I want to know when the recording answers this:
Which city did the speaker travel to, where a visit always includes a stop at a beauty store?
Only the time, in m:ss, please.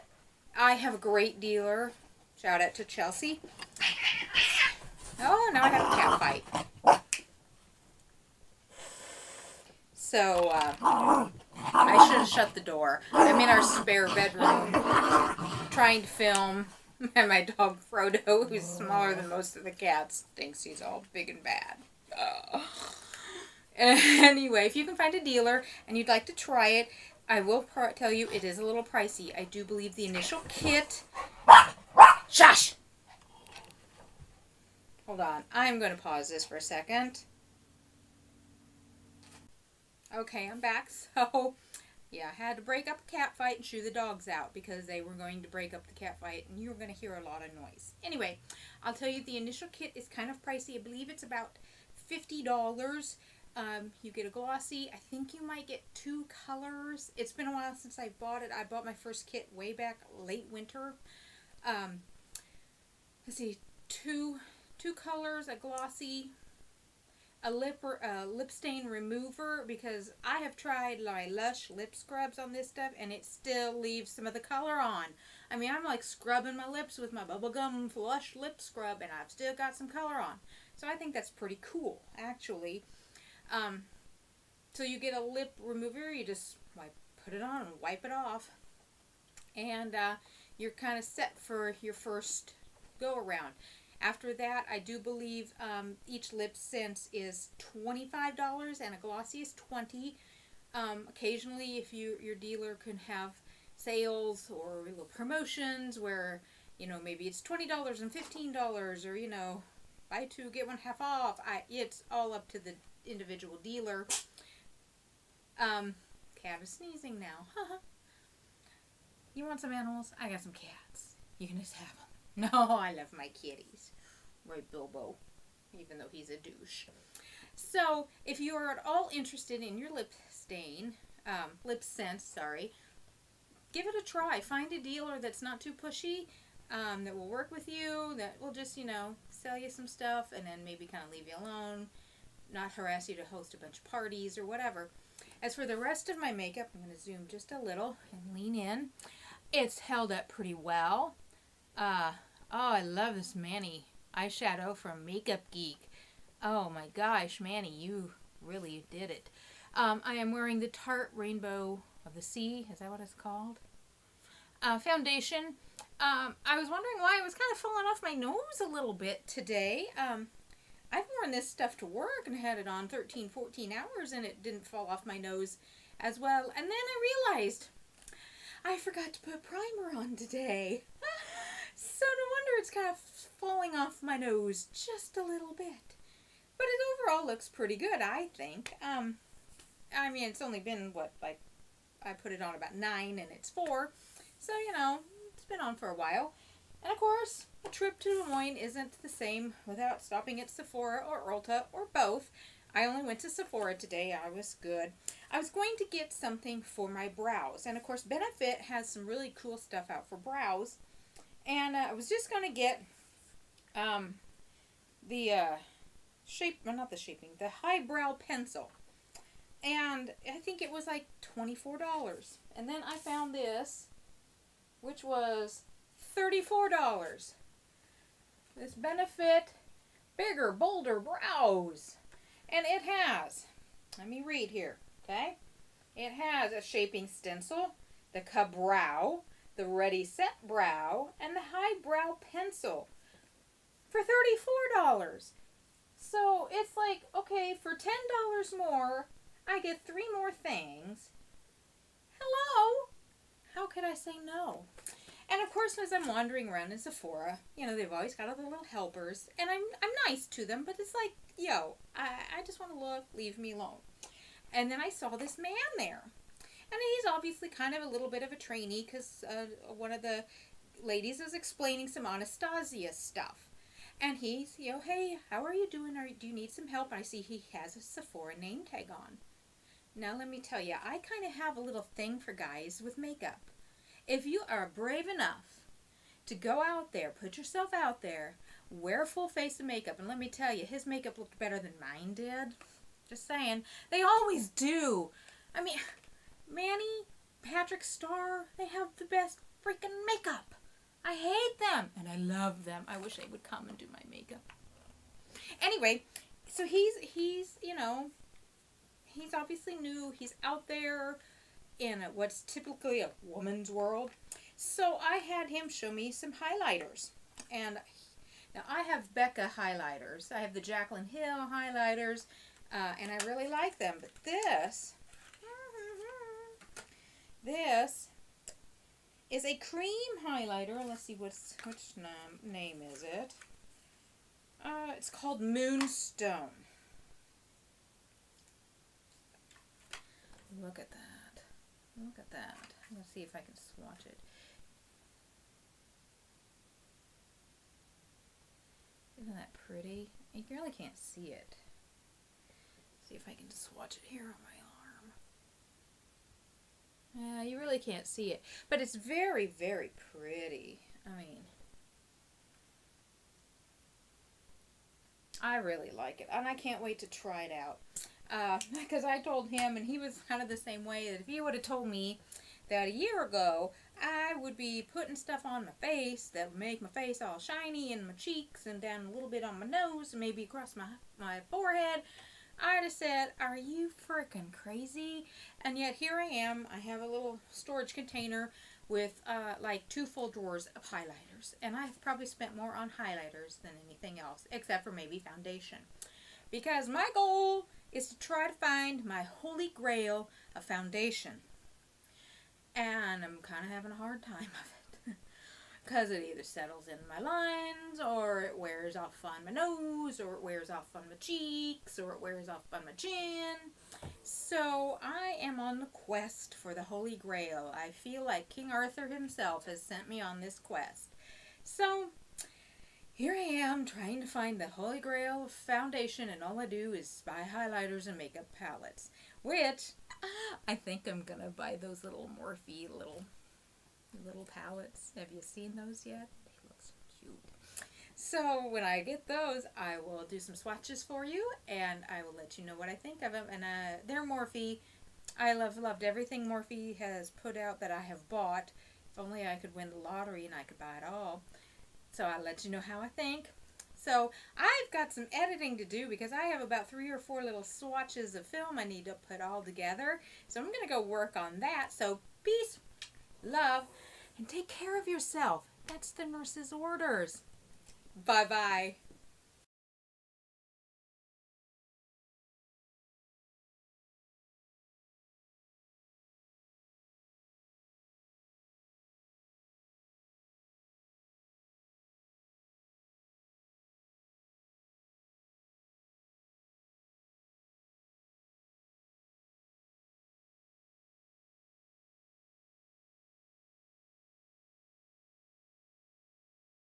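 3:18.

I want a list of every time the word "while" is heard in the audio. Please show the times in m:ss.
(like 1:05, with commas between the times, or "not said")
0:57, 3:15.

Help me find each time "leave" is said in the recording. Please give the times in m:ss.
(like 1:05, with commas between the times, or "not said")
1:13, 2:21, 4:23.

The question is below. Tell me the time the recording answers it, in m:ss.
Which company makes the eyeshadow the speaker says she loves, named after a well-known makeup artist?
2:35.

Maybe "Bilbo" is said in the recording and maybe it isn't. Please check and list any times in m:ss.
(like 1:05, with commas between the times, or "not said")
2:04.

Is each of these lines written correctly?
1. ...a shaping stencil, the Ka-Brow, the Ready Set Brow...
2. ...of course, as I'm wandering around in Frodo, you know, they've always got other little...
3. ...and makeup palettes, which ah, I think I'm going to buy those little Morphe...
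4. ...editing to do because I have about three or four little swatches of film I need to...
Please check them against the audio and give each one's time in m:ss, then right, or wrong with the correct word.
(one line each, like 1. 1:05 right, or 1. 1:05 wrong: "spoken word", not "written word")
1. 3:56 right
2. 4:15 wrong: "Sephora", not "Frodo"
3. 7:08 right
4. 7:35 right.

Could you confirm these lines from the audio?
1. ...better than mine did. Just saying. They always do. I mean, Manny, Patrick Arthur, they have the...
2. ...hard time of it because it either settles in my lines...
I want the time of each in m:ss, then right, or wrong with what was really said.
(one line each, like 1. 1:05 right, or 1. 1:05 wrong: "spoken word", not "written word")
1. 4:51 wrong: "Starr", not "Arthur"
2. 6:43 right.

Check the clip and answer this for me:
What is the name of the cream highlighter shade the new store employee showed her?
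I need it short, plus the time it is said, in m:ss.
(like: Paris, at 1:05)
Moonstone, at 5:35.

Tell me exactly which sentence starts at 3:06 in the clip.
But it overall looks pretty good, I think.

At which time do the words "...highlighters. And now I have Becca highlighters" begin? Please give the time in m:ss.
5:16.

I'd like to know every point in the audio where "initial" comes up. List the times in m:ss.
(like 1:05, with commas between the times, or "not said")
0:30, 0:49.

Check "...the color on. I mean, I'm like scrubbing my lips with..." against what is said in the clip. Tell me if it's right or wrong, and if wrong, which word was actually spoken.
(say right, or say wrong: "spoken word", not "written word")
right.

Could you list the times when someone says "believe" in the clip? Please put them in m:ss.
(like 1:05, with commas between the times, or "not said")
0:29, 0:50, 1:34.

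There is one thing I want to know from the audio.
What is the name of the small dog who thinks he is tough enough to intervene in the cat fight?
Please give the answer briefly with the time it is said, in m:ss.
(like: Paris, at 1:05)
Frodo, at 0:17.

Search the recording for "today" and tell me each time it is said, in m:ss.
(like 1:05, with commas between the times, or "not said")
2:49, 3:00, 3:23.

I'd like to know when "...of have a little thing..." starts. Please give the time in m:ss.
4:41.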